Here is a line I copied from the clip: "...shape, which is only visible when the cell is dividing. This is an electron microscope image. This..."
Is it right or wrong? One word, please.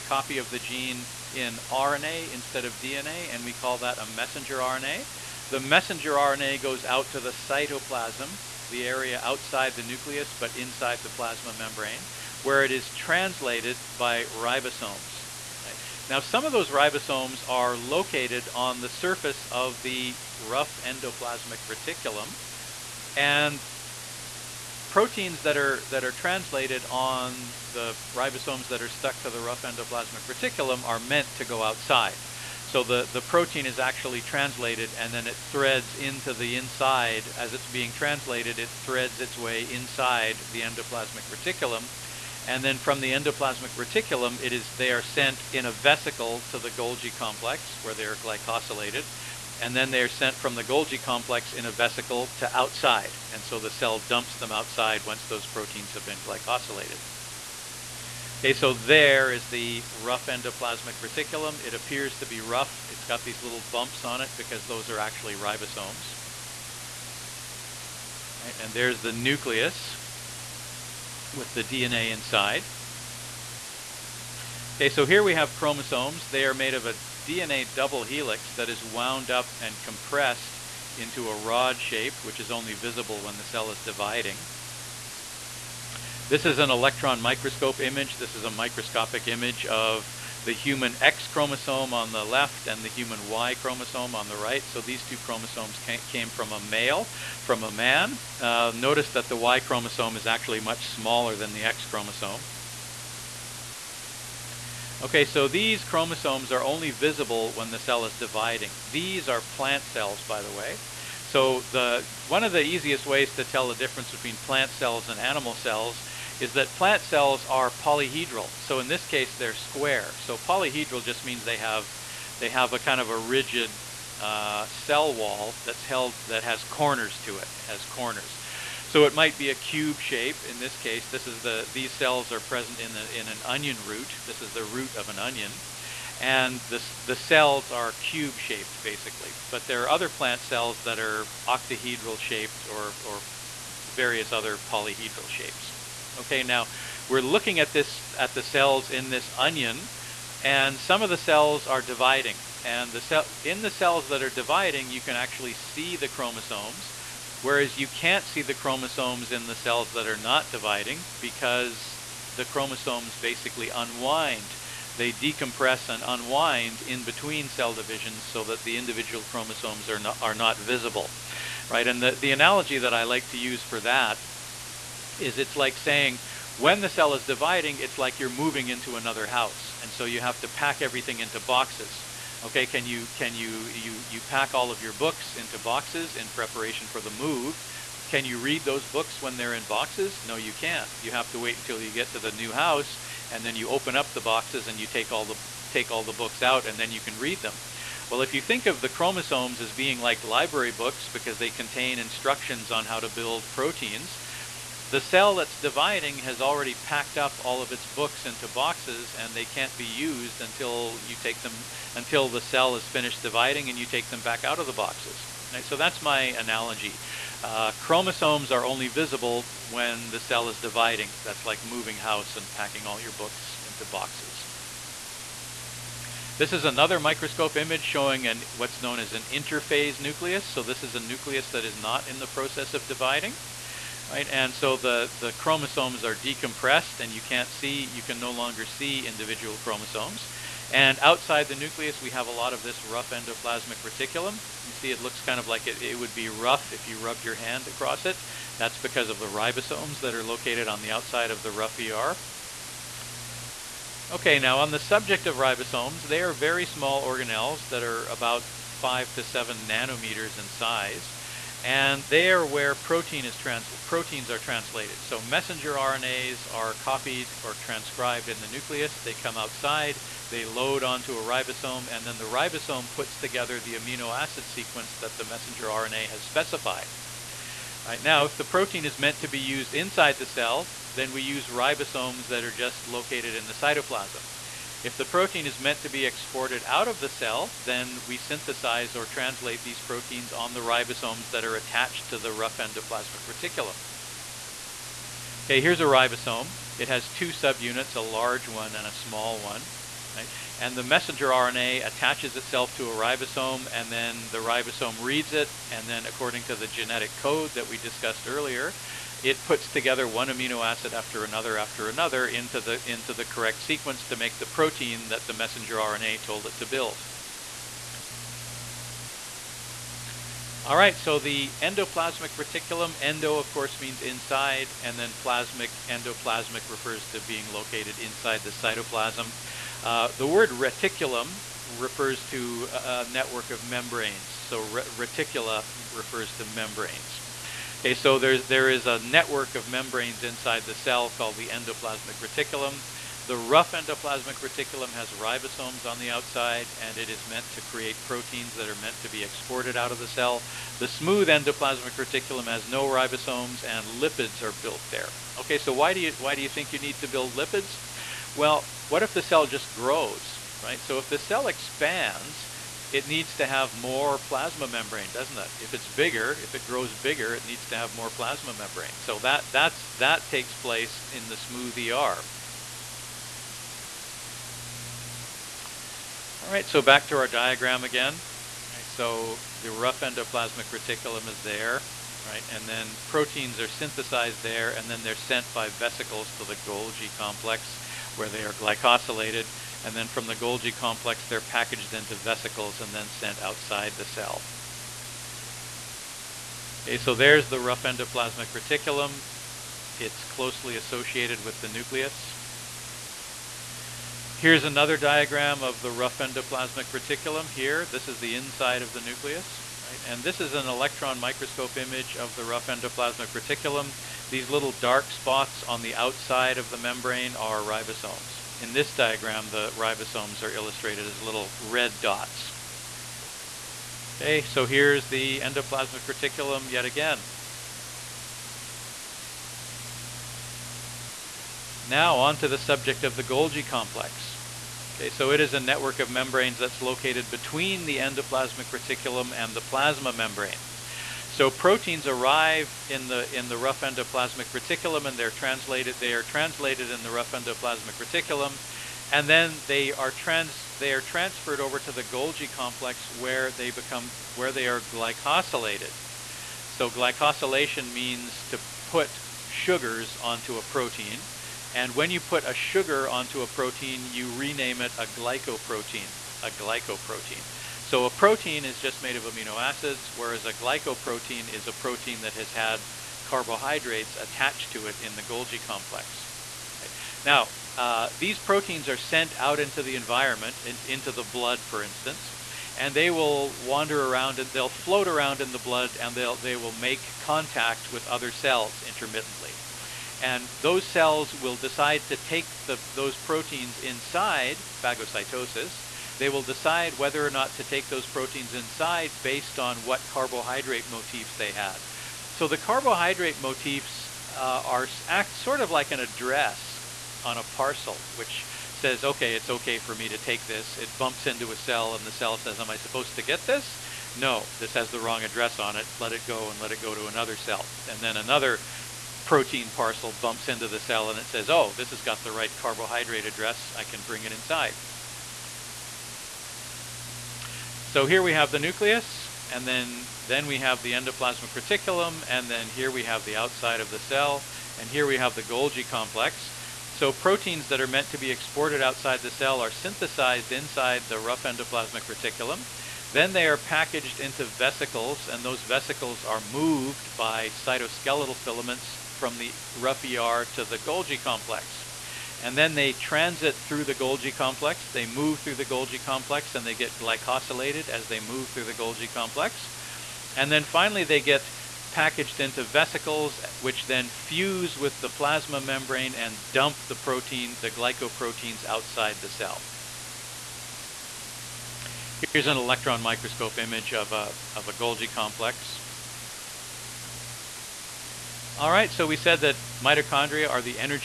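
right.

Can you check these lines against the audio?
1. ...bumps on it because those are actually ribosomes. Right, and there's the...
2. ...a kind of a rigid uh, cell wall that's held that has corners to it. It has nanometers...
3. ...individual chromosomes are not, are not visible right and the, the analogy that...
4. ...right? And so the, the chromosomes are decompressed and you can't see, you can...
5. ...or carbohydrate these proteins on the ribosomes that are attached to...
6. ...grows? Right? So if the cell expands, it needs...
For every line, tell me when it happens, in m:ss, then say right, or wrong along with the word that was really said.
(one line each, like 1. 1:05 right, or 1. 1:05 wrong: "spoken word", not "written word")
1. 1:03 right
2. 2:02 wrong: "corners", not "nanometers"
3. 2:48 right
4. 3:54 right
5. 4:48 wrong: "translate", not "carbohydrate"
6. 5:59 right.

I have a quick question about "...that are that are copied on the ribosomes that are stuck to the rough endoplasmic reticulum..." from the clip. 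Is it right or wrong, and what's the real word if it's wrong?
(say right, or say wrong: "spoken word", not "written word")
wrong: "translated", not "copied".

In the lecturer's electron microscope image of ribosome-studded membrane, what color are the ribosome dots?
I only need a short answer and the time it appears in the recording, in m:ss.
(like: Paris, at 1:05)
Red, at 7:01.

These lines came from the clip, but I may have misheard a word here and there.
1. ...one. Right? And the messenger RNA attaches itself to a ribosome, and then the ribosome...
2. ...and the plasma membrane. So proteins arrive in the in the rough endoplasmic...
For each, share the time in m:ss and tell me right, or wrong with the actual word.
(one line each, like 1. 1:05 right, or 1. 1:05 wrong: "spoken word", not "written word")
1. 4:59 right
2. 7:19 right.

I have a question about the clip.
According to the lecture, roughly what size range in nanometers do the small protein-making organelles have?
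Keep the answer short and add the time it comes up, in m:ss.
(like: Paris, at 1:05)
5 to 7 nanometers, at 4:18.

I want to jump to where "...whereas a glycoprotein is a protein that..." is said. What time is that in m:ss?
7:50.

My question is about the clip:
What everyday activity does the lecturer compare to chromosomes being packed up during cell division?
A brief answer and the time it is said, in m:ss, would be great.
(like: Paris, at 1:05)
Moving house, at 3:41.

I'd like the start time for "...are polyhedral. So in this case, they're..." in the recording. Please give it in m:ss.
1:57.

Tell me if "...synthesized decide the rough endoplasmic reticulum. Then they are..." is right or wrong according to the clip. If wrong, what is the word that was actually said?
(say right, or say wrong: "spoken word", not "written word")
wrong: "inside", not "decide".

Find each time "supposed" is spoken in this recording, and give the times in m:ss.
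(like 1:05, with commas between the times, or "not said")
8:32.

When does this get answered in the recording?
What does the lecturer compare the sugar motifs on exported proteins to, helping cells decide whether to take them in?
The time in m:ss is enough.
8:25.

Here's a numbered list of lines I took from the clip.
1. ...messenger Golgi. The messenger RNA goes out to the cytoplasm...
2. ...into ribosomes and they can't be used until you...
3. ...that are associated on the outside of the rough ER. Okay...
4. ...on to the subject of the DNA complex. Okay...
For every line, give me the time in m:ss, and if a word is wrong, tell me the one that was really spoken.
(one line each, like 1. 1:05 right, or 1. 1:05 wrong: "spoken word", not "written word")
1. 0:04 wrong: "RNA", not "Golgi"
2. 3:28 wrong: "boxes", not "ribosomes"
3. 4:09 wrong: "located", not "associated"
4. 7:12 wrong: "Golgi", not "DNA".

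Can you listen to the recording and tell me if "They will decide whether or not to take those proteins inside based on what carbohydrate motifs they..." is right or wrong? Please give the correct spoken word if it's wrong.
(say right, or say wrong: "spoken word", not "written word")
right.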